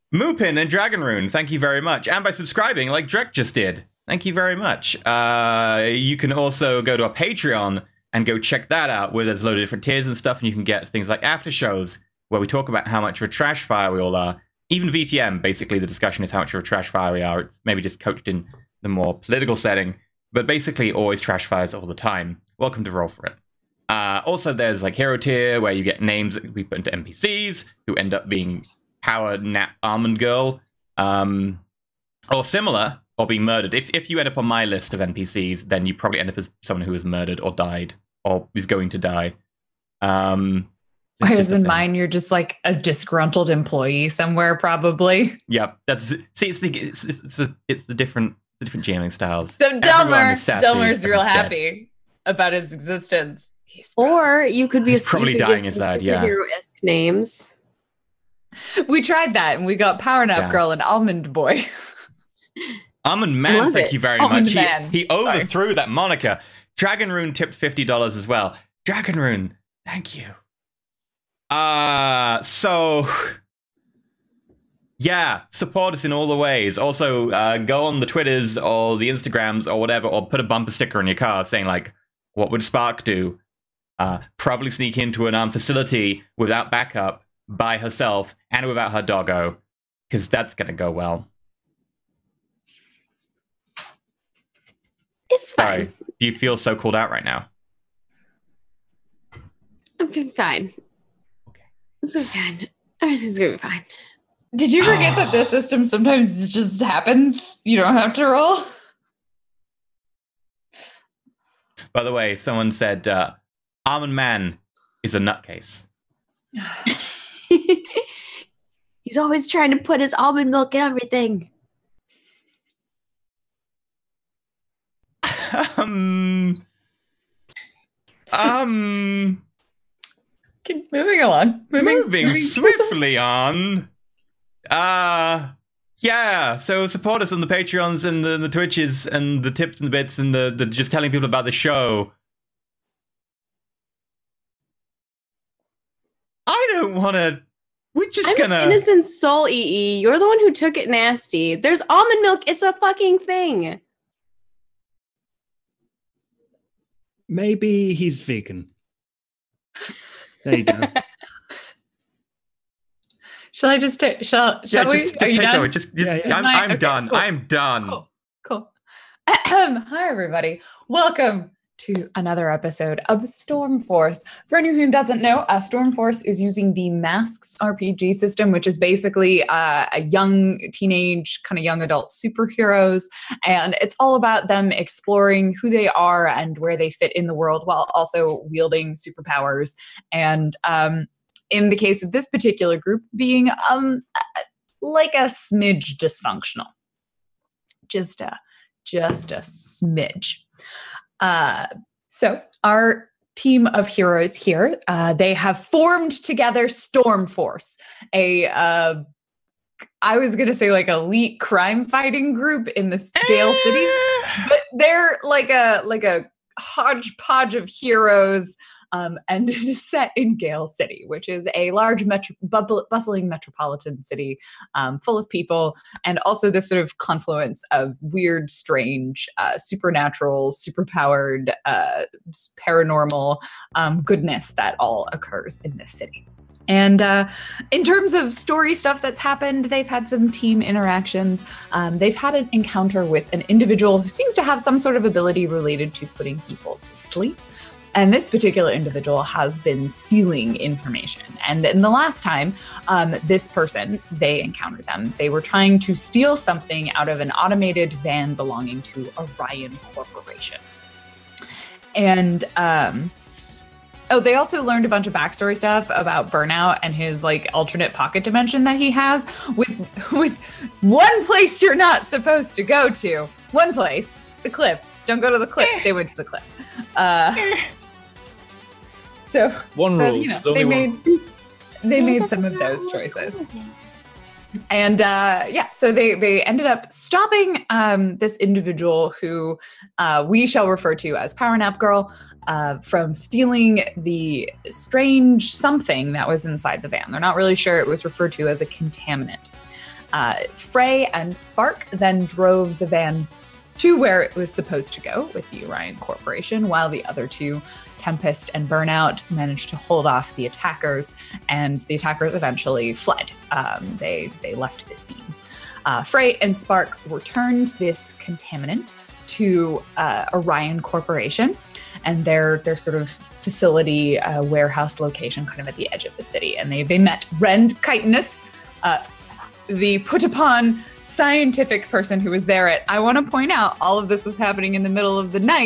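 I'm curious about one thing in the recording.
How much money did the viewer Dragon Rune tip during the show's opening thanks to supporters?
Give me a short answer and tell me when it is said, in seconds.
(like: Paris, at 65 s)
$50, at 67 s.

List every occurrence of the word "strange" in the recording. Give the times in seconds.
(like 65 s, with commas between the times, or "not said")
228 s, 294 s.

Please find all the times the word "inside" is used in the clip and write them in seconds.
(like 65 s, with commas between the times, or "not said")
55 s, 296 s.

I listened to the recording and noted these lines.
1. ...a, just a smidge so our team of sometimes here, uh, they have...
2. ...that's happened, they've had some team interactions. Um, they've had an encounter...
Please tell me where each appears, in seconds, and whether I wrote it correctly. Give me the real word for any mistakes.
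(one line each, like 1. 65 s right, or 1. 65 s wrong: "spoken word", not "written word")
1. 198 s wrong: "heroes", not "sometimes"
2. 239 s right.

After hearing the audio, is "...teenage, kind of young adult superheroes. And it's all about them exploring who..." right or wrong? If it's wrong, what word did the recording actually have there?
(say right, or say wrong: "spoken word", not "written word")
right.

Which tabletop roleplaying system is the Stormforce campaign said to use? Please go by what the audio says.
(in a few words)
Masks.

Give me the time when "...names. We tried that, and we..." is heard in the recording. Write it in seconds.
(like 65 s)
56 s.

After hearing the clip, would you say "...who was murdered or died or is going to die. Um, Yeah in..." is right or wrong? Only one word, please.
wrong.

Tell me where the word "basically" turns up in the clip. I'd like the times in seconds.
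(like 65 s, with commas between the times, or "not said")
15 s, 20 s, 178 s.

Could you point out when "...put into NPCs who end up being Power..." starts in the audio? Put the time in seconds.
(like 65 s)
26 s.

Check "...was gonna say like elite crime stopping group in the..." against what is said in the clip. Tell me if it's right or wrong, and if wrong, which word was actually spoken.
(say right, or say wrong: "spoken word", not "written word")
wrong: "fighting", not "stopping".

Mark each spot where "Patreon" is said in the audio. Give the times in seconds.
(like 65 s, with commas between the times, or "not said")
7 s, 137 s.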